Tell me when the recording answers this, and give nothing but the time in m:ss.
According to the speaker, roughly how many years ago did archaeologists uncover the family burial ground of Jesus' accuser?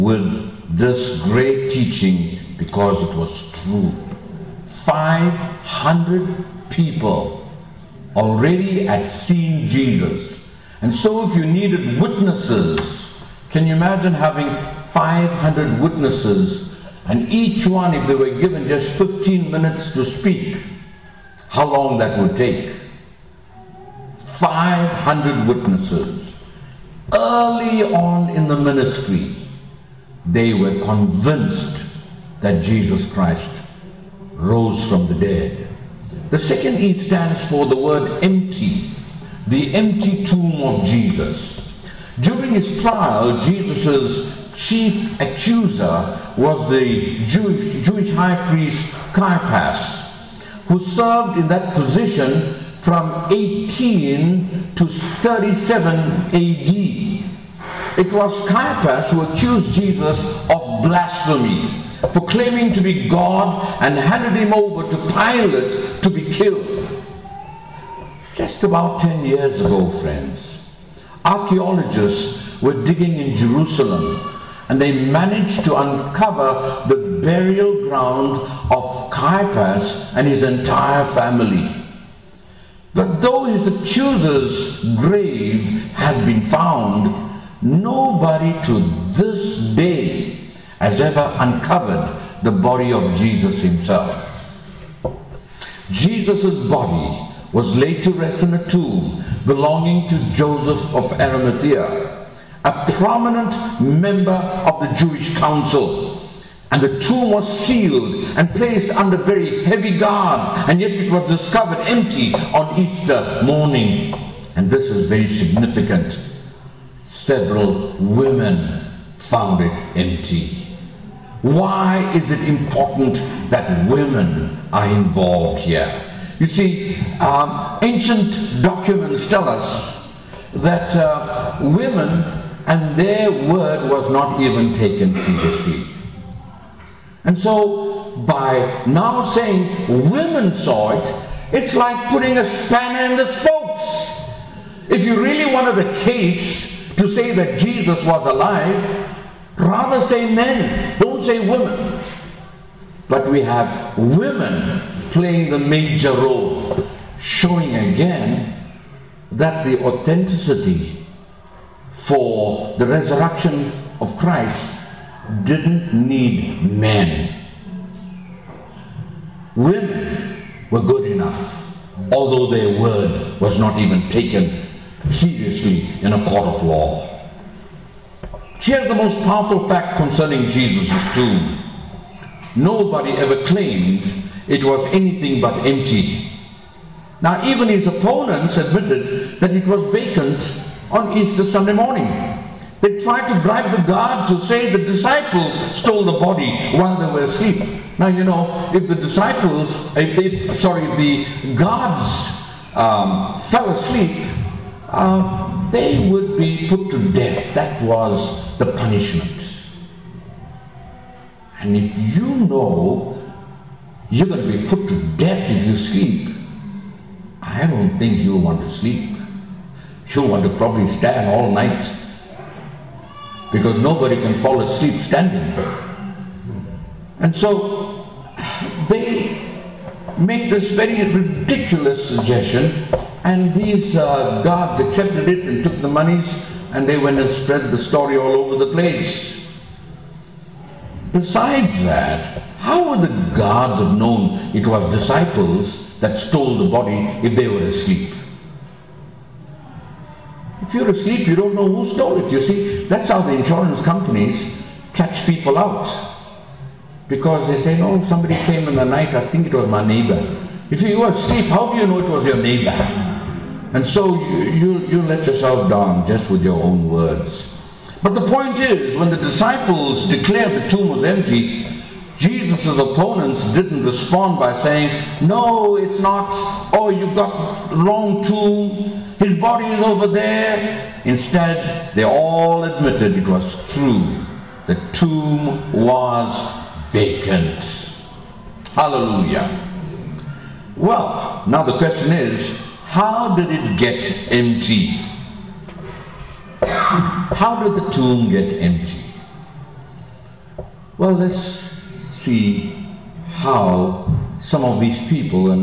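1:09.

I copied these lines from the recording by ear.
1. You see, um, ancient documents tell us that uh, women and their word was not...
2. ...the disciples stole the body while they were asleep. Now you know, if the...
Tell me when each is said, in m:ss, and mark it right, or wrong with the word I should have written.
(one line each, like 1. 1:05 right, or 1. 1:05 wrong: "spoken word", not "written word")
1. 2:06 right
2. 3:14 right.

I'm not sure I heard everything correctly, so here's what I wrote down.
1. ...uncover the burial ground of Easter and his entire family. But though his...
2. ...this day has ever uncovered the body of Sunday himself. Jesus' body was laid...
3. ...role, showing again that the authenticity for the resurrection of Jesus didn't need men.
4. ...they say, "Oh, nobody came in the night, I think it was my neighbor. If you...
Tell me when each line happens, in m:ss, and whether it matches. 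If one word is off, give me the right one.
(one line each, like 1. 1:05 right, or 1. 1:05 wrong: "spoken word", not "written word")
1. 1:15 wrong: "Caiaphas", not "Easter"
2. 1:29 wrong: "Jesus", not "Sunday"
3. 2:36 wrong: "Christ", not "Jesus"
4. 4:17 wrong: "somebody", not "nobody".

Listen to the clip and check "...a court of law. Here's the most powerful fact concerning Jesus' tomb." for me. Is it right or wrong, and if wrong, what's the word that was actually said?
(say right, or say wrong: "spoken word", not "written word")
right.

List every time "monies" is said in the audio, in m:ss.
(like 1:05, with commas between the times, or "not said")
3:55.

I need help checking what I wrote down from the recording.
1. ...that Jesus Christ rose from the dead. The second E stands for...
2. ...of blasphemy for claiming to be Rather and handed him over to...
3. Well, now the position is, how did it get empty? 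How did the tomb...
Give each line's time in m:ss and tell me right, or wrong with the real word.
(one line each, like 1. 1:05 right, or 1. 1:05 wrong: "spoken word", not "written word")
1. 0:32 right
2. 1:00 wrong: "God", not "Rather"
3. 4:50 wrong: "question", not "position".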